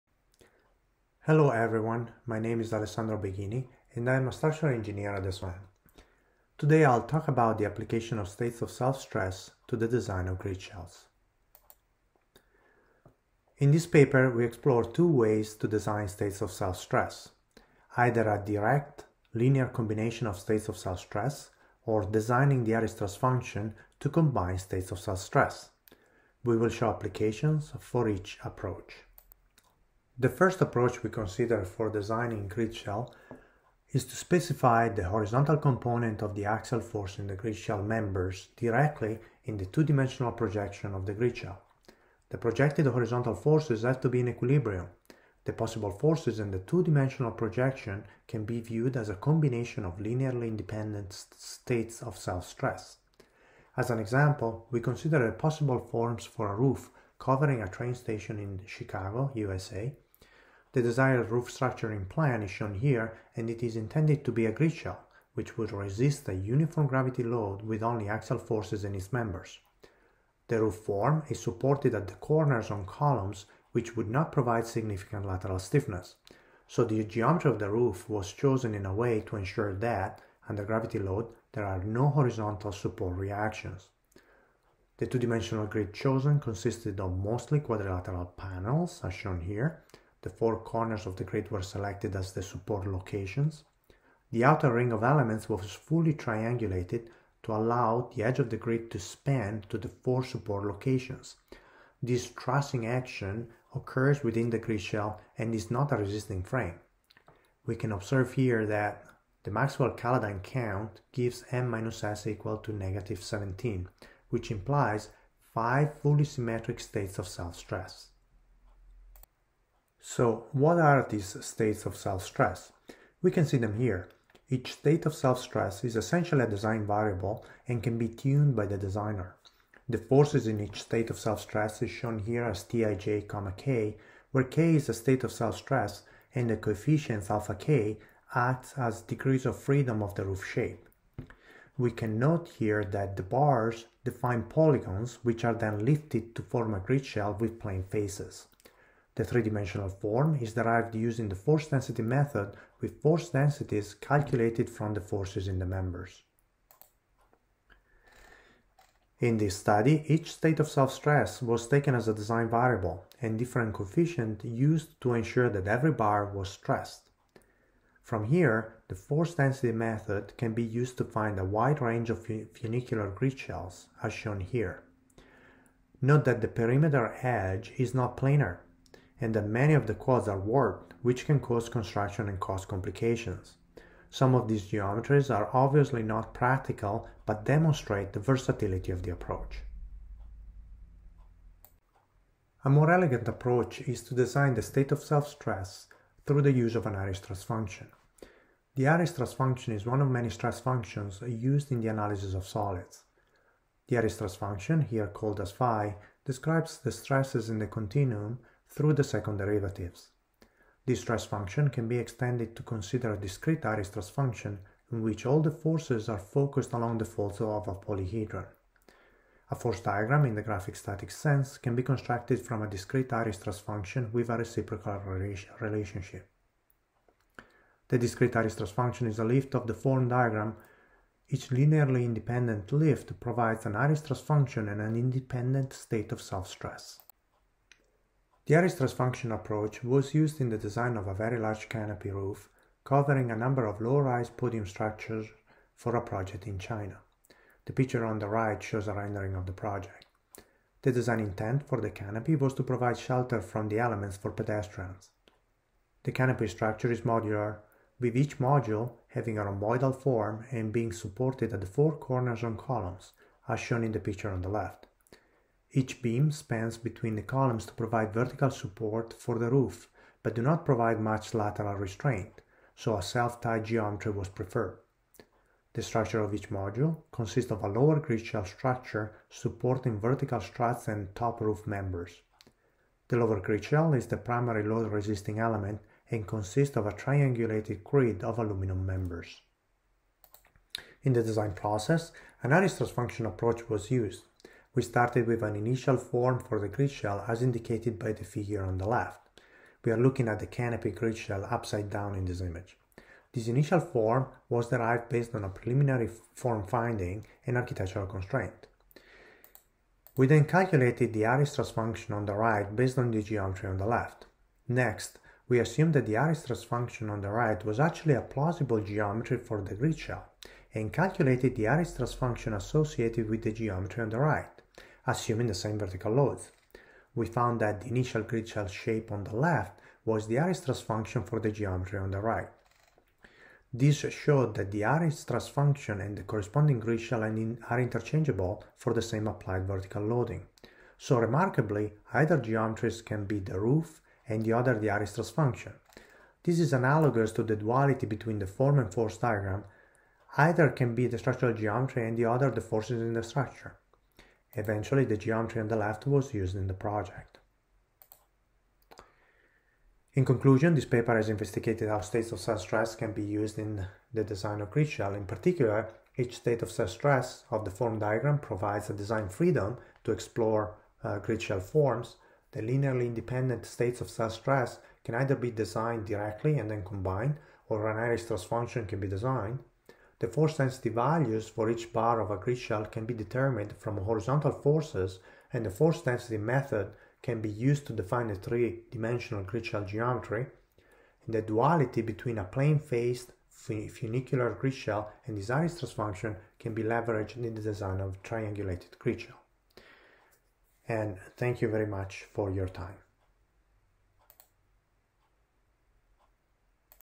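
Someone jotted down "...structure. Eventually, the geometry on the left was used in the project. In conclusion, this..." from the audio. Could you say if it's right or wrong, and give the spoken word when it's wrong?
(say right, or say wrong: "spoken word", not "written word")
right.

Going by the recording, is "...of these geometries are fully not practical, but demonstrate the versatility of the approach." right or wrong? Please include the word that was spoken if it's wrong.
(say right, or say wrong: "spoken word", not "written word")
wrong: "obviously", not "fully".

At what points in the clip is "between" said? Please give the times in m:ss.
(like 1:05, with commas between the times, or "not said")
4:26, 5:48, 6:32.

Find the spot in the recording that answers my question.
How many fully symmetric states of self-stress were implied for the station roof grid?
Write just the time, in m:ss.
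1:55.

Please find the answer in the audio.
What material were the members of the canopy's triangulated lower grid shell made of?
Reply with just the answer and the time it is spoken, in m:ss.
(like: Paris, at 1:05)
Aluminum, at 4:48.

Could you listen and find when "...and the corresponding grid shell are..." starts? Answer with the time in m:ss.
5:35.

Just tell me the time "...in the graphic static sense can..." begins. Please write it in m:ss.
3:40.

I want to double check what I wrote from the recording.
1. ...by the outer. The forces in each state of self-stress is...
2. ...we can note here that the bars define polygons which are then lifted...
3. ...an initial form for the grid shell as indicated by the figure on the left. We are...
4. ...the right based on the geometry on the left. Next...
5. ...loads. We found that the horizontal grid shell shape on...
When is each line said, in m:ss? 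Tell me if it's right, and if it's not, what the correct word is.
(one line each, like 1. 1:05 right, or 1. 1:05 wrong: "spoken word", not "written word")
1. 2:08 wrong: "designer", not "outer"
2. 2:21 right
3. 4:55 right
4. 5:12 right
5. 5:26 wrong: "initial", not "horizontal".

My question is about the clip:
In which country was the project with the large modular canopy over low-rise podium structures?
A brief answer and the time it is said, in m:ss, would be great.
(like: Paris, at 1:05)
China, at 4:06.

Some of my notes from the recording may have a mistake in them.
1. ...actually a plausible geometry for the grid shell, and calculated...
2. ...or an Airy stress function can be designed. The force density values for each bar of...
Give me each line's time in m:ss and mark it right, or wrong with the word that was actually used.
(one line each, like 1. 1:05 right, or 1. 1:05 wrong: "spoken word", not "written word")
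1. 5:17 right
2. 6:17 right.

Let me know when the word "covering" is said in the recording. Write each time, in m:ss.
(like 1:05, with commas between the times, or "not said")
0:57, 4:02.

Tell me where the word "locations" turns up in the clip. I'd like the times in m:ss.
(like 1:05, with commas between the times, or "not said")
1:32, 1:40.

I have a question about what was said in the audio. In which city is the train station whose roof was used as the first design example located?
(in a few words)
Chicago.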